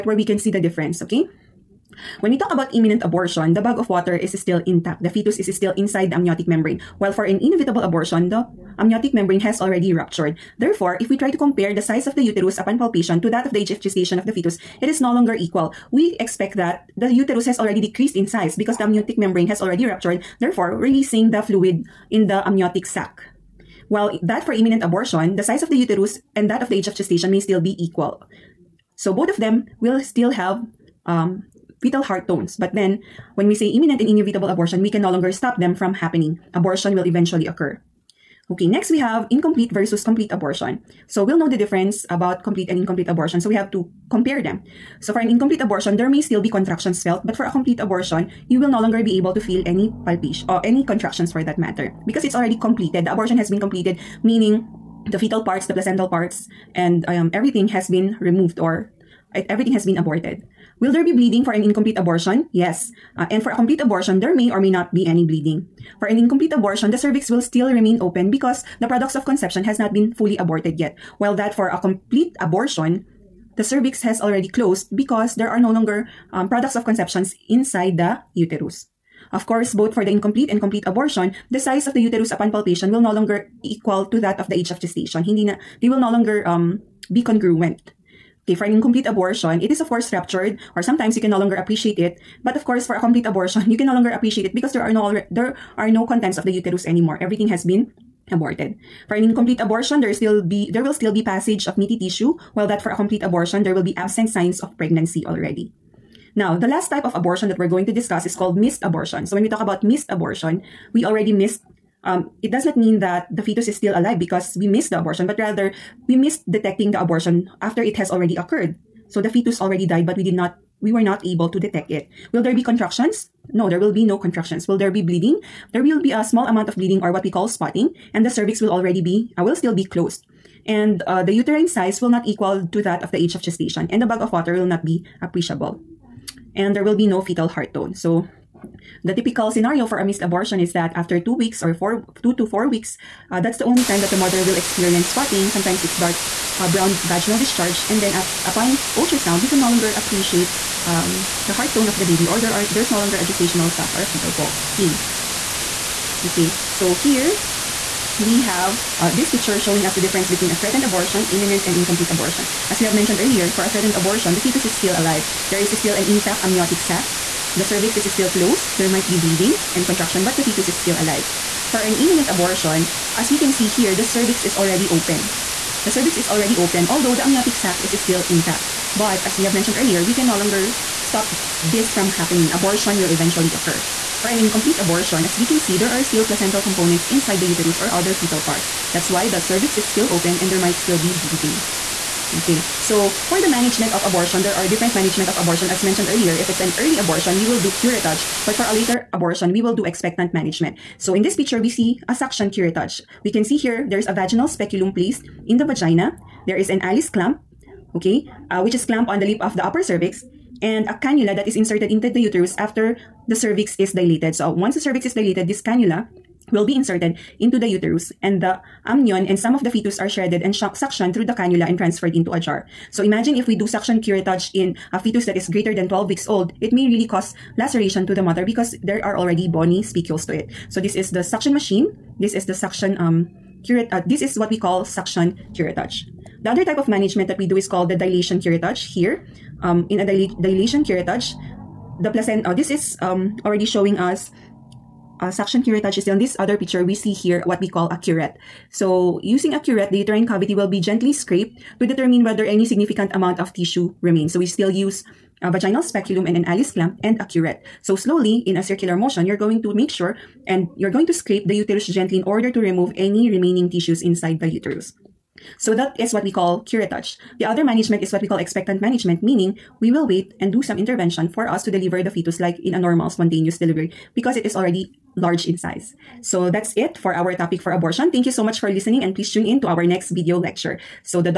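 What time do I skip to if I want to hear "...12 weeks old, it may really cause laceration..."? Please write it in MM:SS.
03:45.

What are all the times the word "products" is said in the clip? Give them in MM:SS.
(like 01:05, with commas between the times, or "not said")
01:08, 01:16.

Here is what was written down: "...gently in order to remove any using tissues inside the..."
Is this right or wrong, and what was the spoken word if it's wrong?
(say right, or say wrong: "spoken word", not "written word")
wrong: "remaining", not "using".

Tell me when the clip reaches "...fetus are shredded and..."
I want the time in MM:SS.
03:39.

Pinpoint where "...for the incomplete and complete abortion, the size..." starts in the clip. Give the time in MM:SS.
01:19.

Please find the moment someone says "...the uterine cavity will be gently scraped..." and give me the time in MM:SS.
04:09.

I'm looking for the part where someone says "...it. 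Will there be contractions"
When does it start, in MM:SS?
02:01.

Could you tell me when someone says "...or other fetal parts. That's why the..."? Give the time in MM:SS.
03:07.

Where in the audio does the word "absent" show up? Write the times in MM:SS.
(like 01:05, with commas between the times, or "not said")
01:43.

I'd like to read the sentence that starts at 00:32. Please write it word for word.
But then, when we say imminent and inevitable abortion, we can no longer stop them from happening.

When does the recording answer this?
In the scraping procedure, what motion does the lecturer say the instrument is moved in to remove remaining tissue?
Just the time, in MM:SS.
04:18.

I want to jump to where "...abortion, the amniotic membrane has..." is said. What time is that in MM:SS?
00:07.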